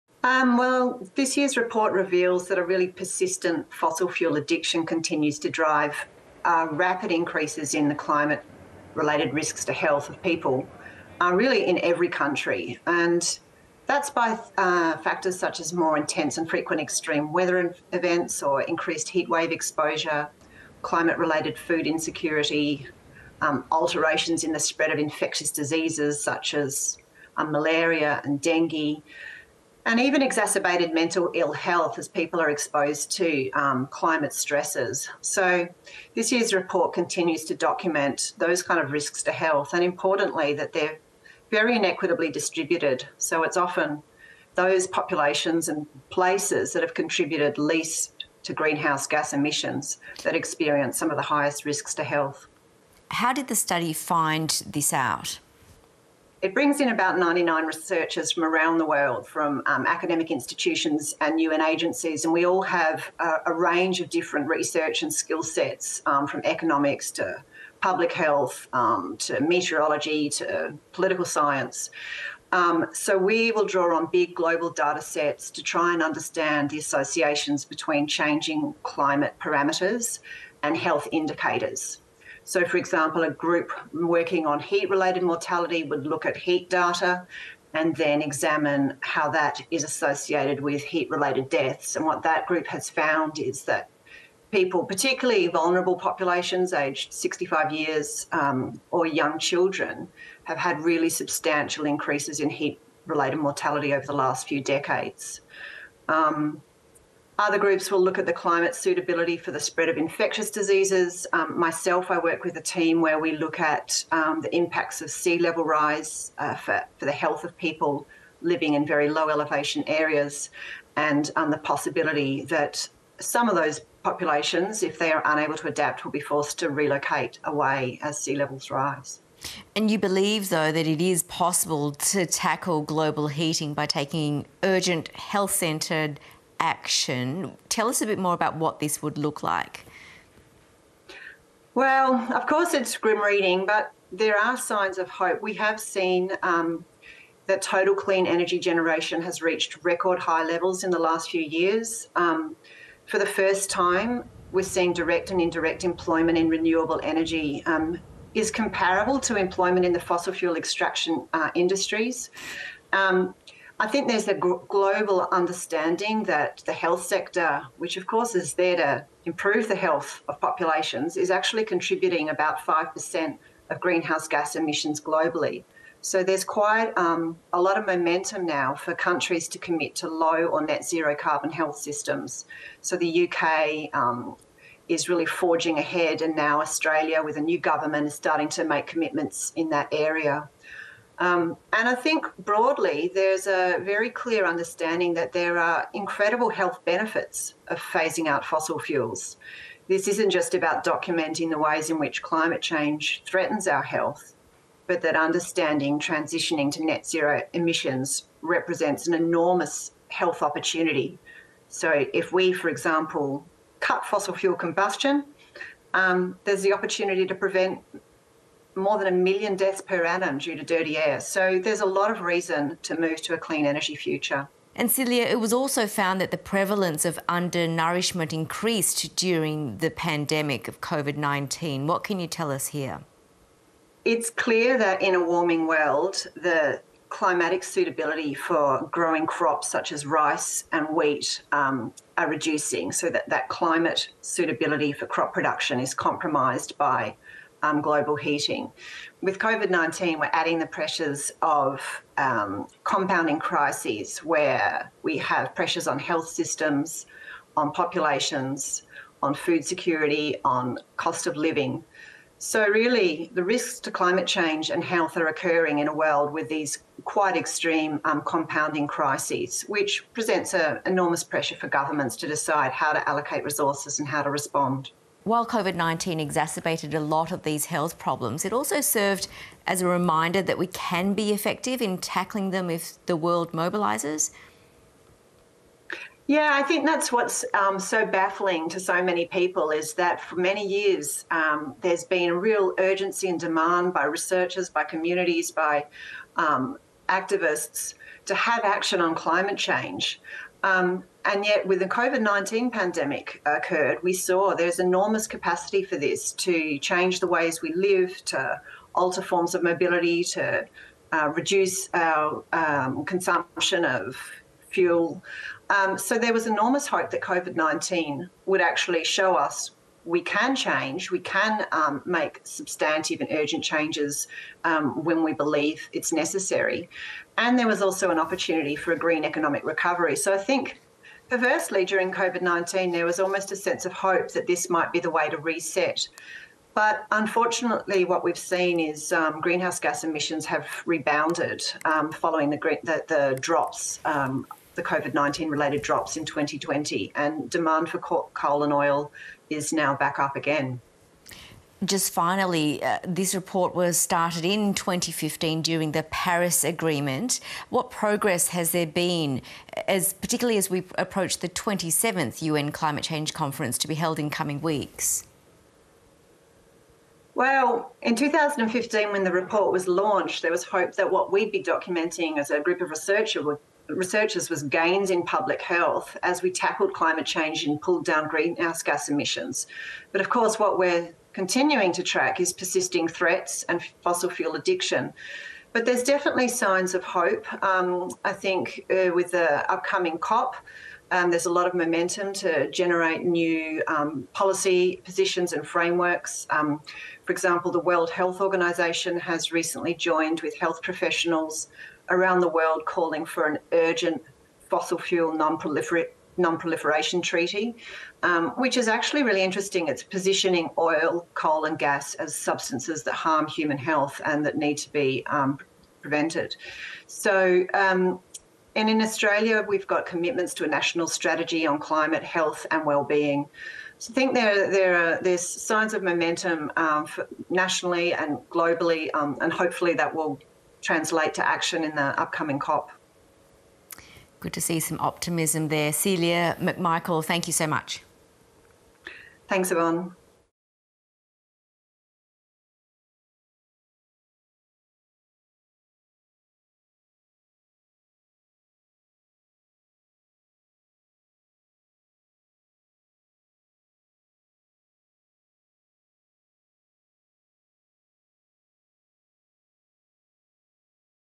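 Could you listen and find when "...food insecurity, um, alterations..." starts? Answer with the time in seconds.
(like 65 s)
21 s.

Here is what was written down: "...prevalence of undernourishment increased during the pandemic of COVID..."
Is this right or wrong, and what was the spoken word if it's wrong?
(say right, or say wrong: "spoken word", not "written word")
right.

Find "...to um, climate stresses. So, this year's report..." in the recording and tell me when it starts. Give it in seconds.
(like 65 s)
33 s.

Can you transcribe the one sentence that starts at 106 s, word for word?
Um, other groups will look at the climate suitability for the spread of infectious diseases.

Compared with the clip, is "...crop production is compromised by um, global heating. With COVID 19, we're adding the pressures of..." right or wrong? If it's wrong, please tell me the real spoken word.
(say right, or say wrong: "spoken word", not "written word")
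right.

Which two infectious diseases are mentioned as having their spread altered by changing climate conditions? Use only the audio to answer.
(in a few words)
malaria and dengue.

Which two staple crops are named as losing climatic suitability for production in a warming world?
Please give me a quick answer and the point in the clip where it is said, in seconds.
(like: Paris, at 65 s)
rice and wheat, at 240 s.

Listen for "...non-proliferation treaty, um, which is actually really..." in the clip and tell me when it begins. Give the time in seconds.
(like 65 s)
406 s.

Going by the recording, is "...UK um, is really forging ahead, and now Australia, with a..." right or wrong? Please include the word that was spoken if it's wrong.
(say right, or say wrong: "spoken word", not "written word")
right.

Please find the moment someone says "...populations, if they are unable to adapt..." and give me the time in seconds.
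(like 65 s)
124 s.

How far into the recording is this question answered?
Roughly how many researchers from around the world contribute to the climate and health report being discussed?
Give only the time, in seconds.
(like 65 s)
57 s.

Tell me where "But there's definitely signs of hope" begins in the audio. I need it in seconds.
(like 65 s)
385 s.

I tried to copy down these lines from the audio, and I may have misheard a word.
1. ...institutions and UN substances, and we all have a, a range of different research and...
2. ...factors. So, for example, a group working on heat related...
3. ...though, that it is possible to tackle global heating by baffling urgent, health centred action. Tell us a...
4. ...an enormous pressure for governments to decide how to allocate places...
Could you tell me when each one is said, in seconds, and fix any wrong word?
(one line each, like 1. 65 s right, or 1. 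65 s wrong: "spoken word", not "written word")
1. 60 s wrong: "agencies", not "substances"
2. 81 s wrong: "indicators", not "factors"
3. 130 s wrong: "taking", not "baffling"
4. 270 s wrong: "resources", not "places".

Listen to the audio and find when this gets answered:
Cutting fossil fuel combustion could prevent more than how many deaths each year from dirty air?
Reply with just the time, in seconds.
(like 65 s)
219 s.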